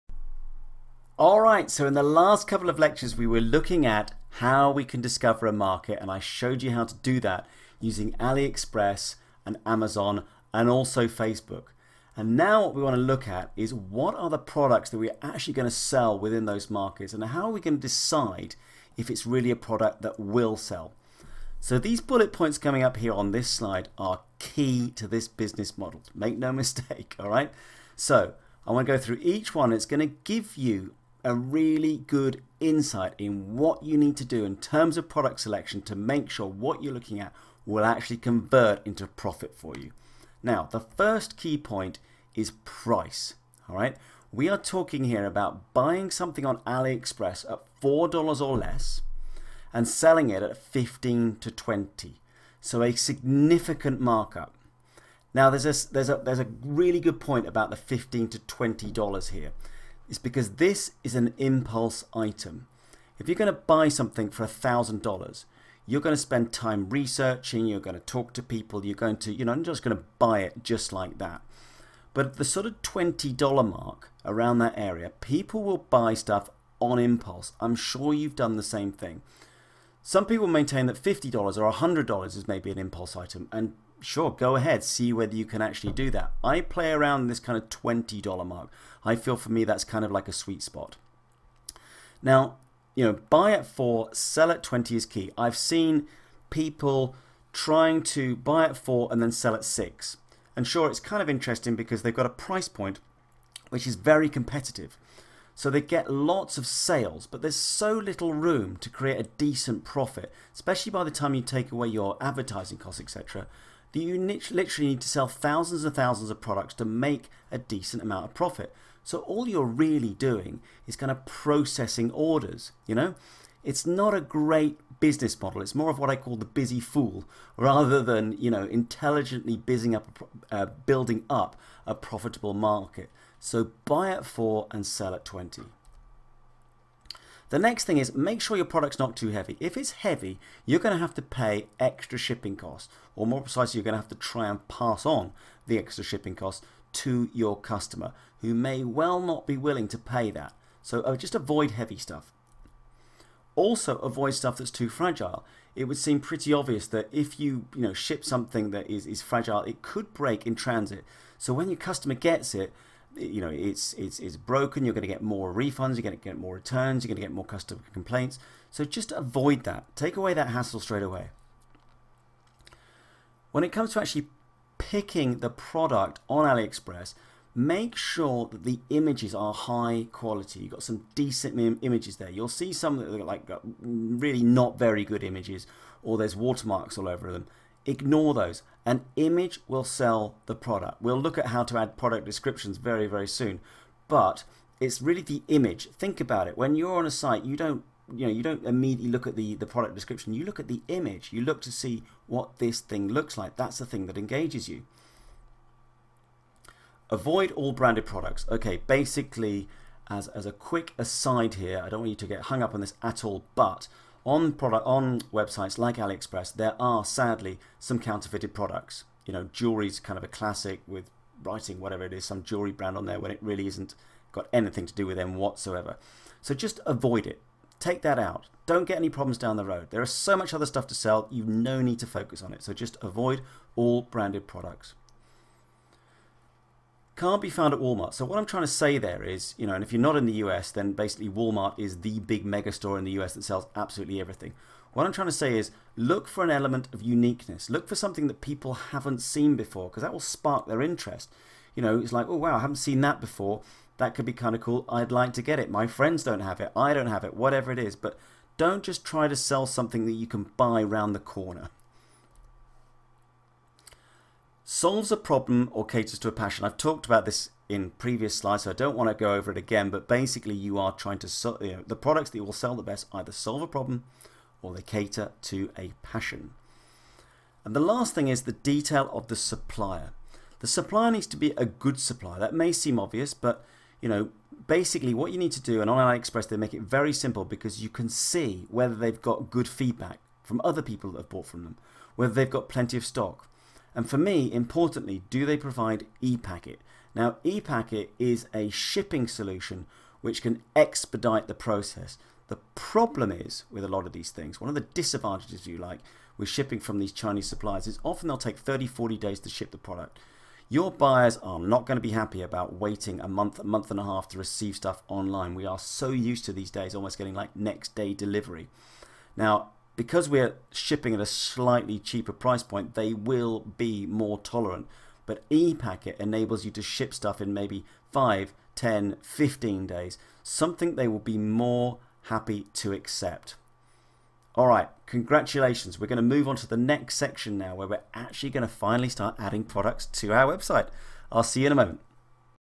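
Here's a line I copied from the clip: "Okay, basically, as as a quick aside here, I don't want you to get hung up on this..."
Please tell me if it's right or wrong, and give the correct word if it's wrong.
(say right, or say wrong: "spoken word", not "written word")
right.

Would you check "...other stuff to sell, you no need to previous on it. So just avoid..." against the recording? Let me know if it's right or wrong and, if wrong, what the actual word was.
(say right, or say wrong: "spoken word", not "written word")
wrong: "focus", not "previous".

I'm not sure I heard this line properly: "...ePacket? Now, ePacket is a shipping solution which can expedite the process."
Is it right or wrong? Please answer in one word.
right.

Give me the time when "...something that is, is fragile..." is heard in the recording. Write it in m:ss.
2:38.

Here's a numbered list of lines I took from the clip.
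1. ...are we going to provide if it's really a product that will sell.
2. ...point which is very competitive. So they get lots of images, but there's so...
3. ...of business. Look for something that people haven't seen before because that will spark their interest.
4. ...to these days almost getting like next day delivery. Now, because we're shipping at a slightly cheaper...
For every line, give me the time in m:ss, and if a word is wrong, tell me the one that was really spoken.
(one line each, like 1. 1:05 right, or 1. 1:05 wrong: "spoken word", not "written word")
1. 0:17 wrong: "decide", not "provide"
2. 1:42 wrong: "sales", not "images"
3. 4:06 wrong: "uniqueness", not "business"
4. 5:16 right.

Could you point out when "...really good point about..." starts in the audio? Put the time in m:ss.
0:56.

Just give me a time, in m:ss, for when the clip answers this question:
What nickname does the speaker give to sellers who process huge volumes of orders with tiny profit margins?
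2:06.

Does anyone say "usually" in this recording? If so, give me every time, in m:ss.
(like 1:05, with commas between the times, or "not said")
not said.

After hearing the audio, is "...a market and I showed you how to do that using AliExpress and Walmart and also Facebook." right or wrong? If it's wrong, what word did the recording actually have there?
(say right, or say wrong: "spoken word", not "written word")
wrong: "Amazon", not "Walmart".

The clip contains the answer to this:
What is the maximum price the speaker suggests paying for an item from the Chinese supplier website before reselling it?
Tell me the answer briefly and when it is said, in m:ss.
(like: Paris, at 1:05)
$4, at 0:47.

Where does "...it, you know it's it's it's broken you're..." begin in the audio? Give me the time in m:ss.
2:42.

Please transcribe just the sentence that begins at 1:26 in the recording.
I play around this kind of $20 mark.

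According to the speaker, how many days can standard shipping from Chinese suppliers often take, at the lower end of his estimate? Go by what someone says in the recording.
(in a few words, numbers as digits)
30.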